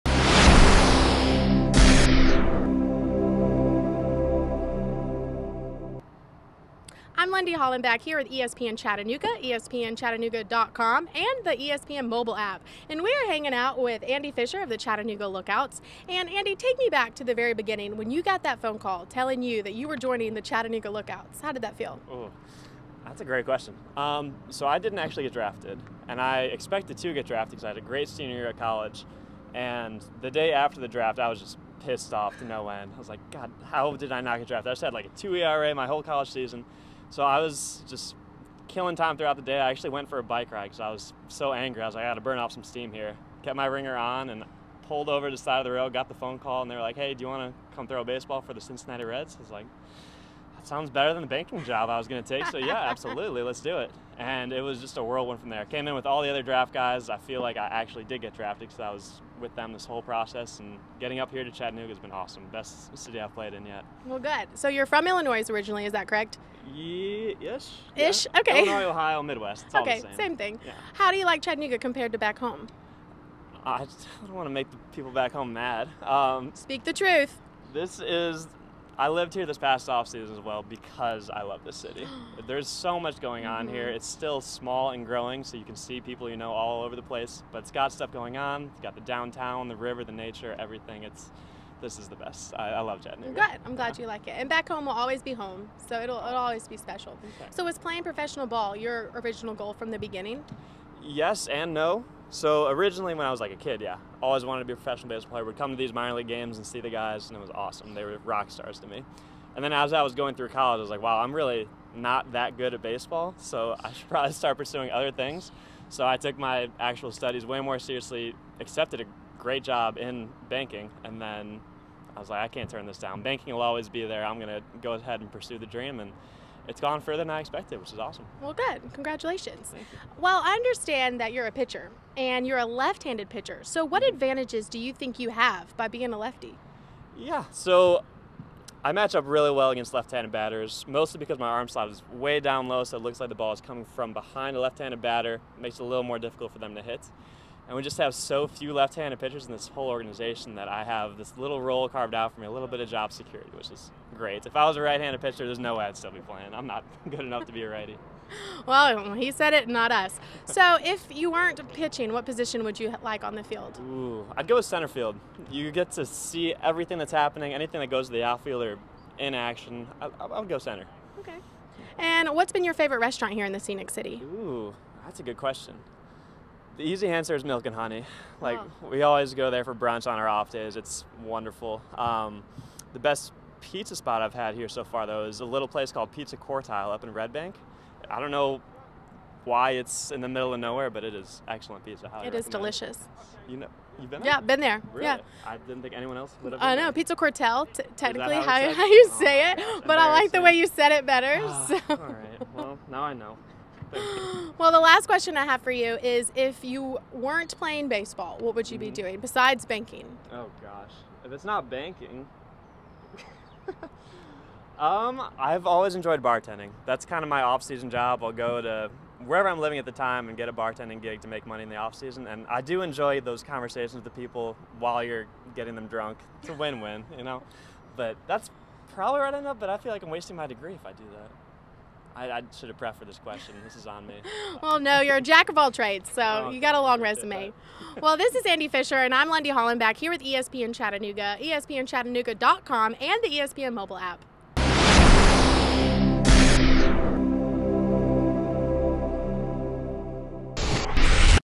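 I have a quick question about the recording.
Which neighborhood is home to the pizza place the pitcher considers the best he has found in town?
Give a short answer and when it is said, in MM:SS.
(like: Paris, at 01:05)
Red Bank, at 03:07.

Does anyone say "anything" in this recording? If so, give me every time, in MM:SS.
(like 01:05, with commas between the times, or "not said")
02:47.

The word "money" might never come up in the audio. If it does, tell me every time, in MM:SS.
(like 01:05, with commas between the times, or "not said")
03:41.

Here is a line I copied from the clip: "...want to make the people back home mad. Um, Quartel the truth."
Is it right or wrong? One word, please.
wrong.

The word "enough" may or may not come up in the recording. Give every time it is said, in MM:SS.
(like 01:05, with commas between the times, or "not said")
02:37, 03:49.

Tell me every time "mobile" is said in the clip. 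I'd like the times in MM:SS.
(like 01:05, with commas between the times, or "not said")
00:12, 04:03.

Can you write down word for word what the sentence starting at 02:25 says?
It makes it a little more difficult for them to hit.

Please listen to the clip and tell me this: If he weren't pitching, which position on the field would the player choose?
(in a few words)
center field.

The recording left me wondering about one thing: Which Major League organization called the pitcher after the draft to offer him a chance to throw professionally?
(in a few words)
Cincinnati Reds.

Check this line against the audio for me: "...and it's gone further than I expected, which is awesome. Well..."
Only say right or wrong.
right.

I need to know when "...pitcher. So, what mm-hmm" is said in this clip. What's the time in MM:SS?
02:13.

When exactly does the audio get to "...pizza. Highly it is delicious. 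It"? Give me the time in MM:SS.
03:11.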